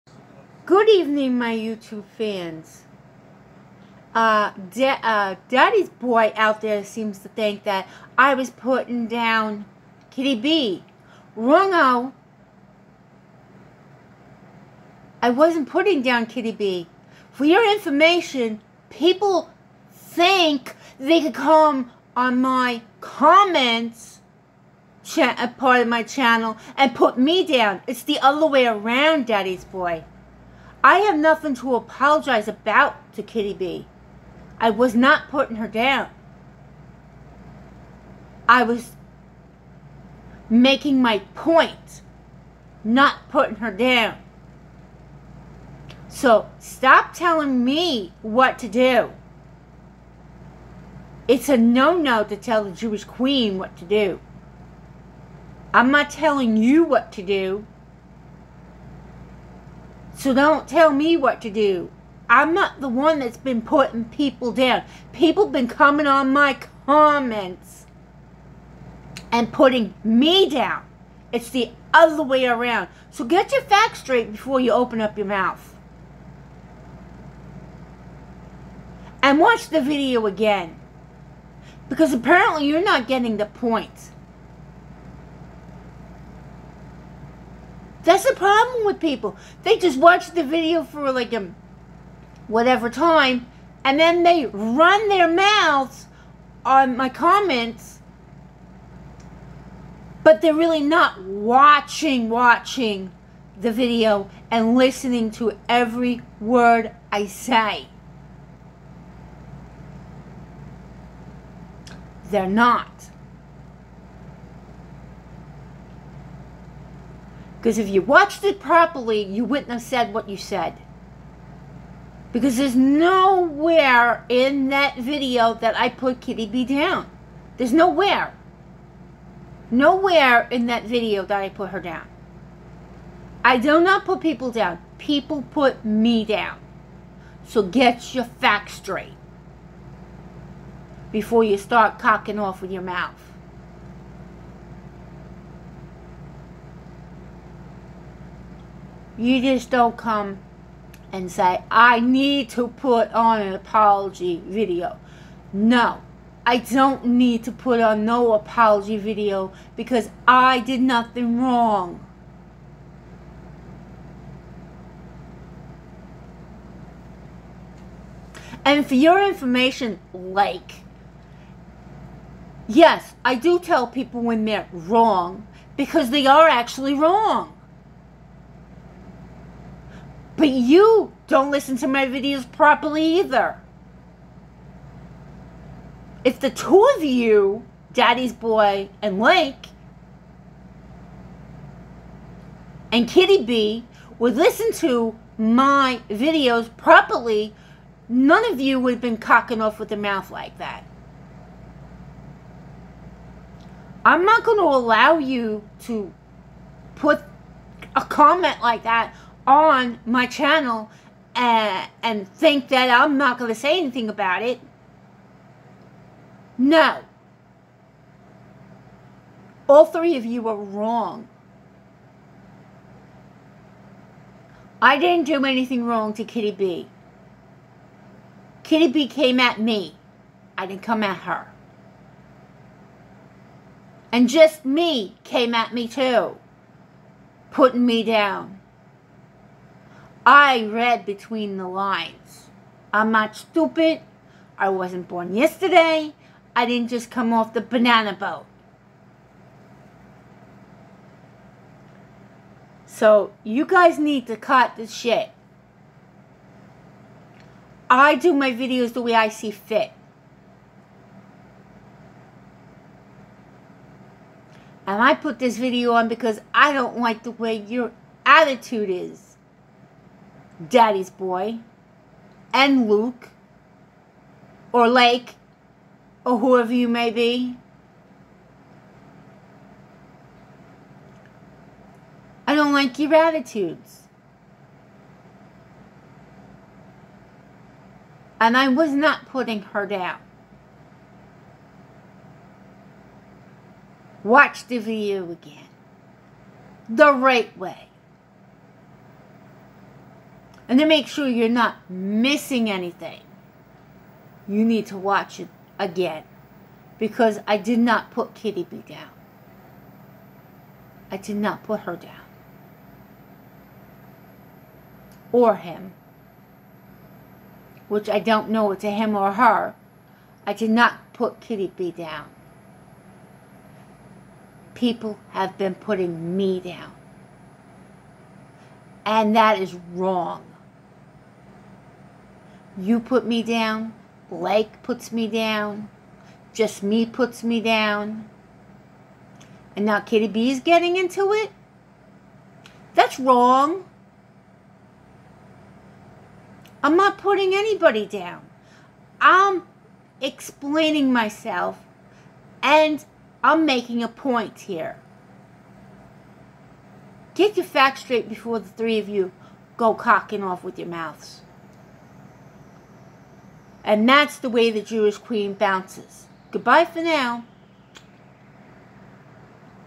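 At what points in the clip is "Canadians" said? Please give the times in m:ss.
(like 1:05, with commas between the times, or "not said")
not said.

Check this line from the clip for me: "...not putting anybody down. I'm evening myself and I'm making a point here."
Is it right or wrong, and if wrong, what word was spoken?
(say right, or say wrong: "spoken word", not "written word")
wrong: "explaining", not "evening".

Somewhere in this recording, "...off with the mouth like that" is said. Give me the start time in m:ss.
3:19.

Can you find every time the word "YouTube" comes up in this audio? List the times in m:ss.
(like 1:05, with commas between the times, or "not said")
0:01.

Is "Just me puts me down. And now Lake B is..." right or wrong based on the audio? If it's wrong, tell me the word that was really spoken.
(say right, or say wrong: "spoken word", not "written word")
wrong: "Kitty", not "Lake".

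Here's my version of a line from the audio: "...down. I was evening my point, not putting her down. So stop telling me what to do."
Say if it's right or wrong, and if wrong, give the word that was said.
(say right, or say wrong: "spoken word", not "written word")
wrong: "making", not "evening".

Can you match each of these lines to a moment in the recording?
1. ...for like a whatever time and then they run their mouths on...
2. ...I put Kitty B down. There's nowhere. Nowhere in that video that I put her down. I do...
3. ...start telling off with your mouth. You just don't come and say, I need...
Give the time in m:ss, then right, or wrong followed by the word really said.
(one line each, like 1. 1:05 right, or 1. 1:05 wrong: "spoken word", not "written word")
1. 1:30 right
2. 2:05 right
3. 2:21 wrong: "cocking", not "telling".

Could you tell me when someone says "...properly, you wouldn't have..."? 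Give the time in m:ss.
1:58.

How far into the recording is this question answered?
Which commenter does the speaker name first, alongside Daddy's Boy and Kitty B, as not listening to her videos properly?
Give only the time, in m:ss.
3:09.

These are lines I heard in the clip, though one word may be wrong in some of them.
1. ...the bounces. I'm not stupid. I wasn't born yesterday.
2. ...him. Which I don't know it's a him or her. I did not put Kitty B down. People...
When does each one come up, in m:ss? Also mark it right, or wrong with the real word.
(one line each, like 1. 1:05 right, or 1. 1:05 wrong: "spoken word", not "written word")
1. 4:01 wrong: "lines", not "bounces"
2. 5:15 right.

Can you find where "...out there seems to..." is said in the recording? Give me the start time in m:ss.
0:06.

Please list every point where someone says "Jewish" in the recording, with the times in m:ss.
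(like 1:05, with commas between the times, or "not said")
0:52, 6:04.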